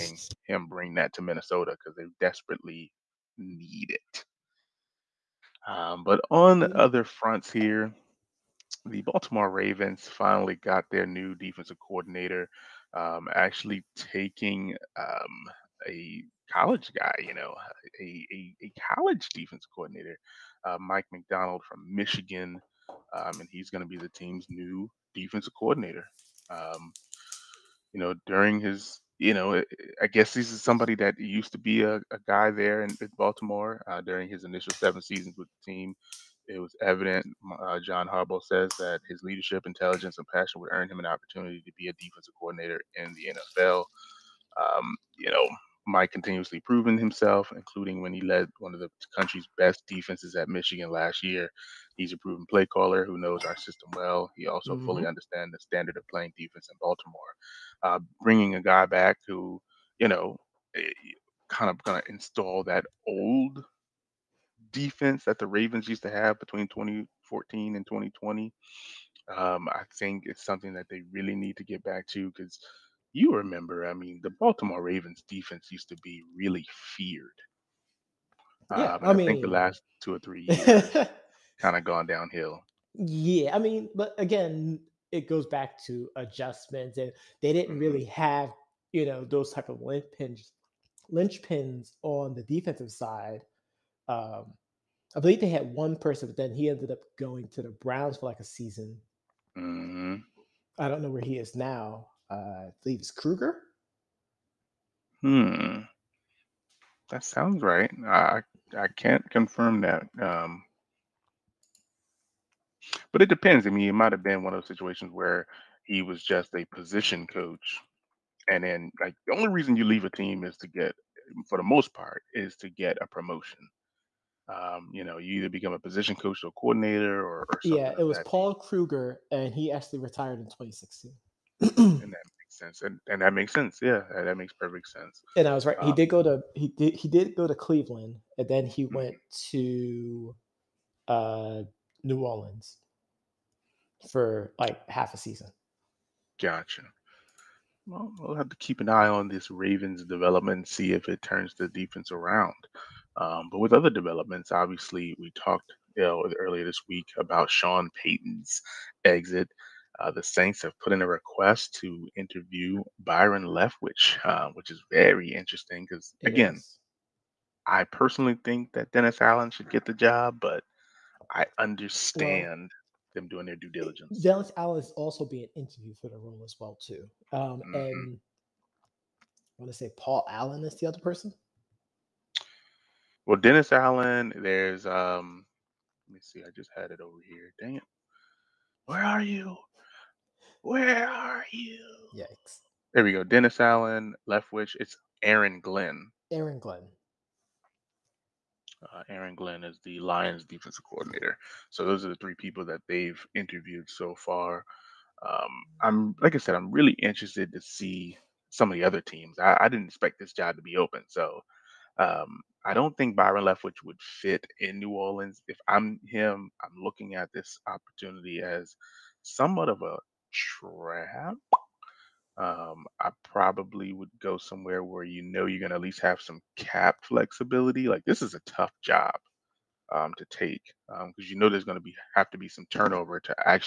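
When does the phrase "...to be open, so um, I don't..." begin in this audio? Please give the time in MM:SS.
03:30.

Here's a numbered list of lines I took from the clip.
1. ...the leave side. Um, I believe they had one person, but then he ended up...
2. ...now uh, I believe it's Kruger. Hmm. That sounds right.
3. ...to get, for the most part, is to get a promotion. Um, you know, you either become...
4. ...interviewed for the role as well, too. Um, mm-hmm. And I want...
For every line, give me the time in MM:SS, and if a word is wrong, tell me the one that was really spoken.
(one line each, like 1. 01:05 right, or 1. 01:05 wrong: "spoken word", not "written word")
1. 01:32 wrong: "defensive", not "leave"
2. 01:41 right
3. 02:00 right
4. 02:55 right.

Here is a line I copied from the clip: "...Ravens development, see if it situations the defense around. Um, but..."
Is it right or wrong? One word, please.
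wrong.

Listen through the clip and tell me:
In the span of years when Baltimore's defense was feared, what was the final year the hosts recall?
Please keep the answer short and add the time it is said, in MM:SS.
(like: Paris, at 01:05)
2020, at 01:07.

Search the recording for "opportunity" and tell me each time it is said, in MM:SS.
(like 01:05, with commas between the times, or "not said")
00:41, 03:37.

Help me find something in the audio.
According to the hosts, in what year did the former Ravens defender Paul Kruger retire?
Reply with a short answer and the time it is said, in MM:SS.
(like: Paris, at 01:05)
2016, at 02:10.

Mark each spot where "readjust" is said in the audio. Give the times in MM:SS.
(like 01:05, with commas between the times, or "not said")
not said.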